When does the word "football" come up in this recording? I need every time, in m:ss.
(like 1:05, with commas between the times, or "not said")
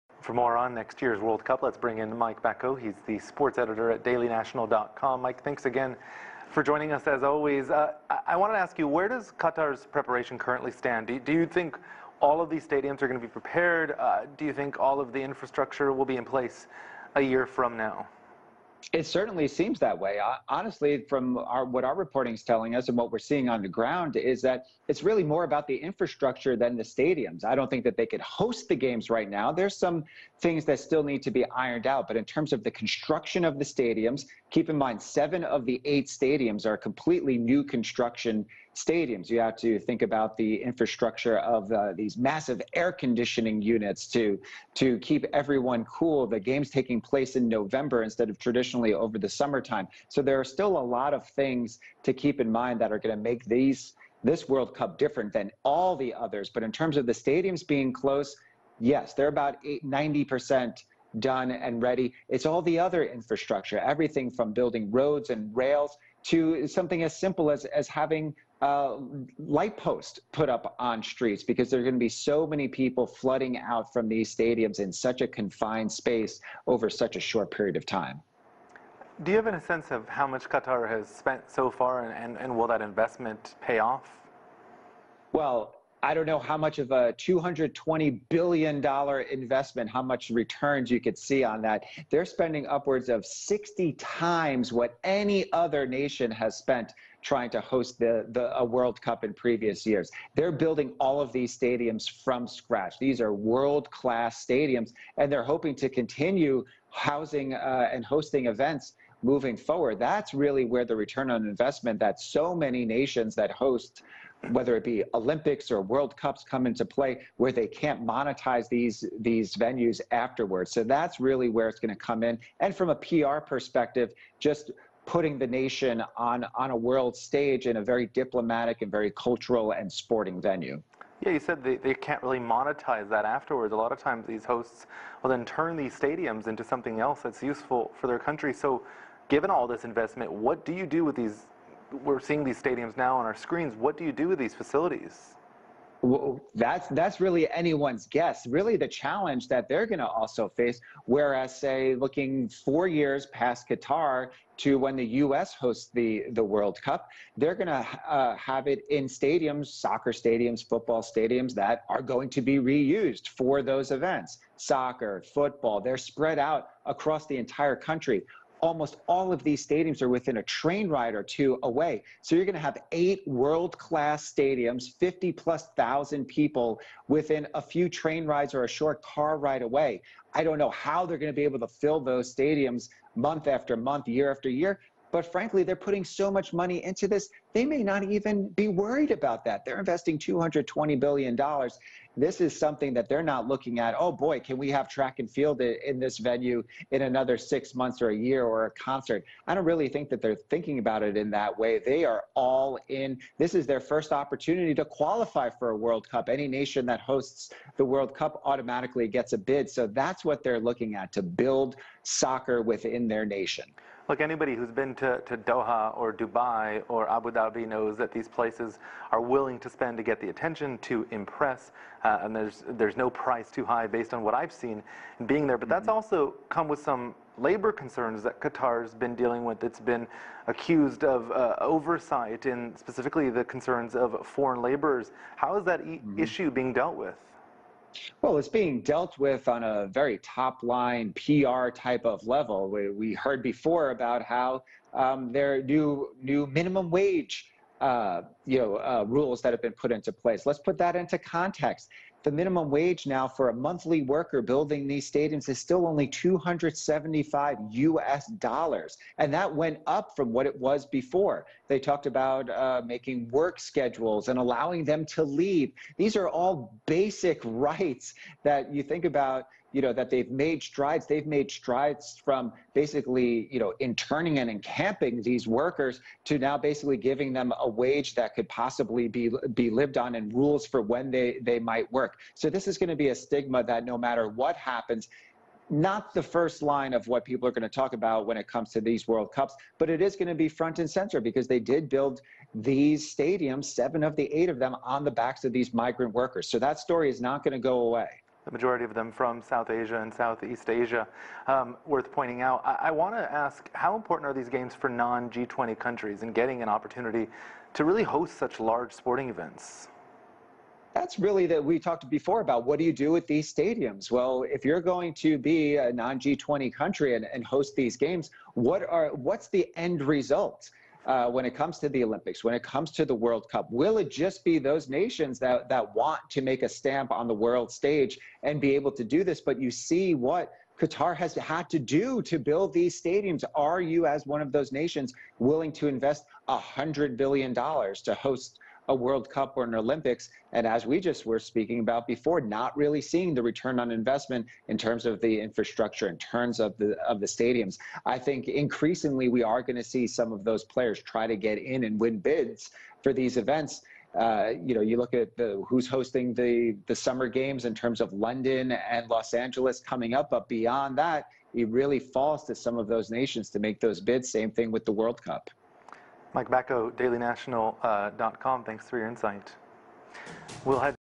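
2:40, 2:45.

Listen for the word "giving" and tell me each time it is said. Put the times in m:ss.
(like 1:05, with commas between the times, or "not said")
4:36.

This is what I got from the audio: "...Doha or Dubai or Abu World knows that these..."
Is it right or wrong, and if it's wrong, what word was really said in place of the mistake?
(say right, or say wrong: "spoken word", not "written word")
wrong: "Dhabi", not "World".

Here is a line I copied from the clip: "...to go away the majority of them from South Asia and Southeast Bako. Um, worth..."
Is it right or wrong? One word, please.
wrong.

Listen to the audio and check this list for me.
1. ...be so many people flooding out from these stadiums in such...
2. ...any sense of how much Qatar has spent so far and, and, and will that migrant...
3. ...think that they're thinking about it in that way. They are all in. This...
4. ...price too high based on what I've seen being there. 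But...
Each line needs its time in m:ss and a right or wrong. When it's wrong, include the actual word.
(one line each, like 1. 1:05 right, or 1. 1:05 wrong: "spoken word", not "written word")
1. 1:11 right
2. 1:19 wrong: "investment", not "migrant"
3. 3:19 right
4. 3:43 right.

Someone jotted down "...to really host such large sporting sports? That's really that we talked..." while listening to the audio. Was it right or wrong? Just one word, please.
wrong.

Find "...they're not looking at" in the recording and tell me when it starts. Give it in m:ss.
3:13.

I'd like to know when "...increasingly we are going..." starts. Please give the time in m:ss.
5:48.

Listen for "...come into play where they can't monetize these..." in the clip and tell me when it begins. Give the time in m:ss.
1:56.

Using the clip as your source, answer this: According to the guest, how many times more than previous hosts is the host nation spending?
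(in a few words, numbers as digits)
60 times.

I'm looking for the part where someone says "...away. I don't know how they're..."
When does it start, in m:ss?
2:59.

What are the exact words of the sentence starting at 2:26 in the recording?
Well, that's that's really anyone's guess.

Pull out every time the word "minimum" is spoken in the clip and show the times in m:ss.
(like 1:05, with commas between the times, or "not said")
4:06, 4:12.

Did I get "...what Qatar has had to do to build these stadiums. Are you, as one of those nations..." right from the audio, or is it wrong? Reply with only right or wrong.
right.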